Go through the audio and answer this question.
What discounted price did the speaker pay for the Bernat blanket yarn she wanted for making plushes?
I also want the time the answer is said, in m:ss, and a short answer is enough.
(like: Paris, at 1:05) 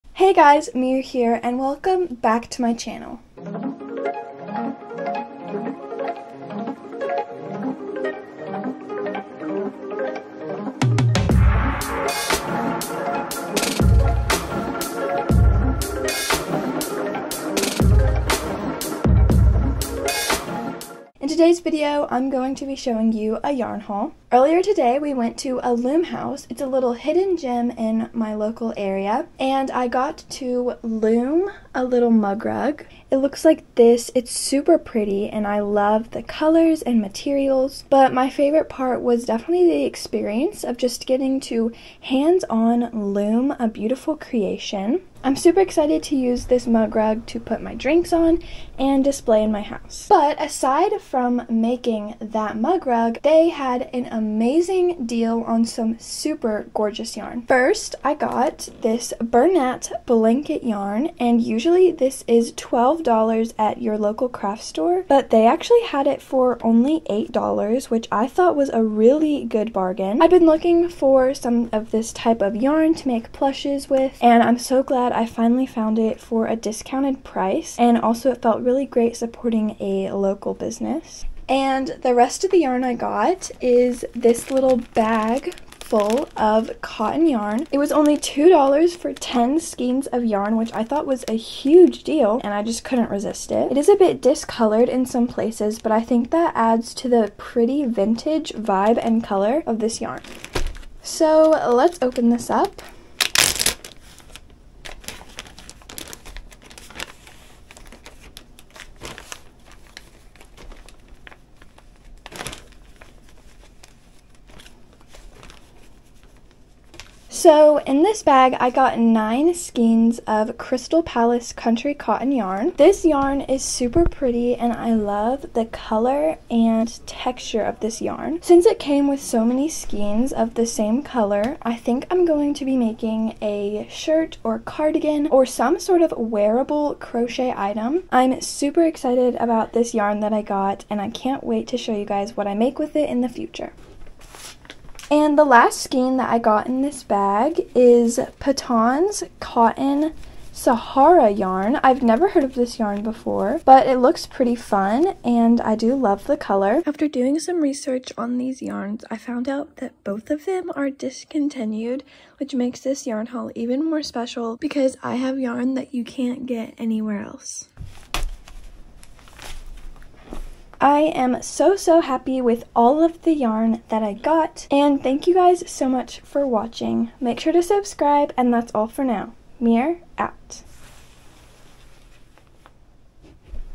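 $8, at 1:07.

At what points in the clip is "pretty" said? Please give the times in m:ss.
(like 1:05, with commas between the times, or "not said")
0:34, 1:37, 2:04, 2:34.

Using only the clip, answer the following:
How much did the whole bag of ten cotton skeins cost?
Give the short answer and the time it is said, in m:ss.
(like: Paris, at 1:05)
$2, at 1:28.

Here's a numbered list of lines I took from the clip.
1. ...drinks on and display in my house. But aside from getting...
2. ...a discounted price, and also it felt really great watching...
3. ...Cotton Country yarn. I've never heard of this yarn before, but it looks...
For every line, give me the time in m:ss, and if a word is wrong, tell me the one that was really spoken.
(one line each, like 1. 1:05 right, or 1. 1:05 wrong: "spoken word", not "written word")
1. 0:47 wrong: "making", not "getting"
2. 1:16 wrong: "supporting", not "watching"
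3. 2:29 wrong: "Sahara", not "Country".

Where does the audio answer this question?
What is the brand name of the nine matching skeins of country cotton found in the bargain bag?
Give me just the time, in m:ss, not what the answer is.
2:00.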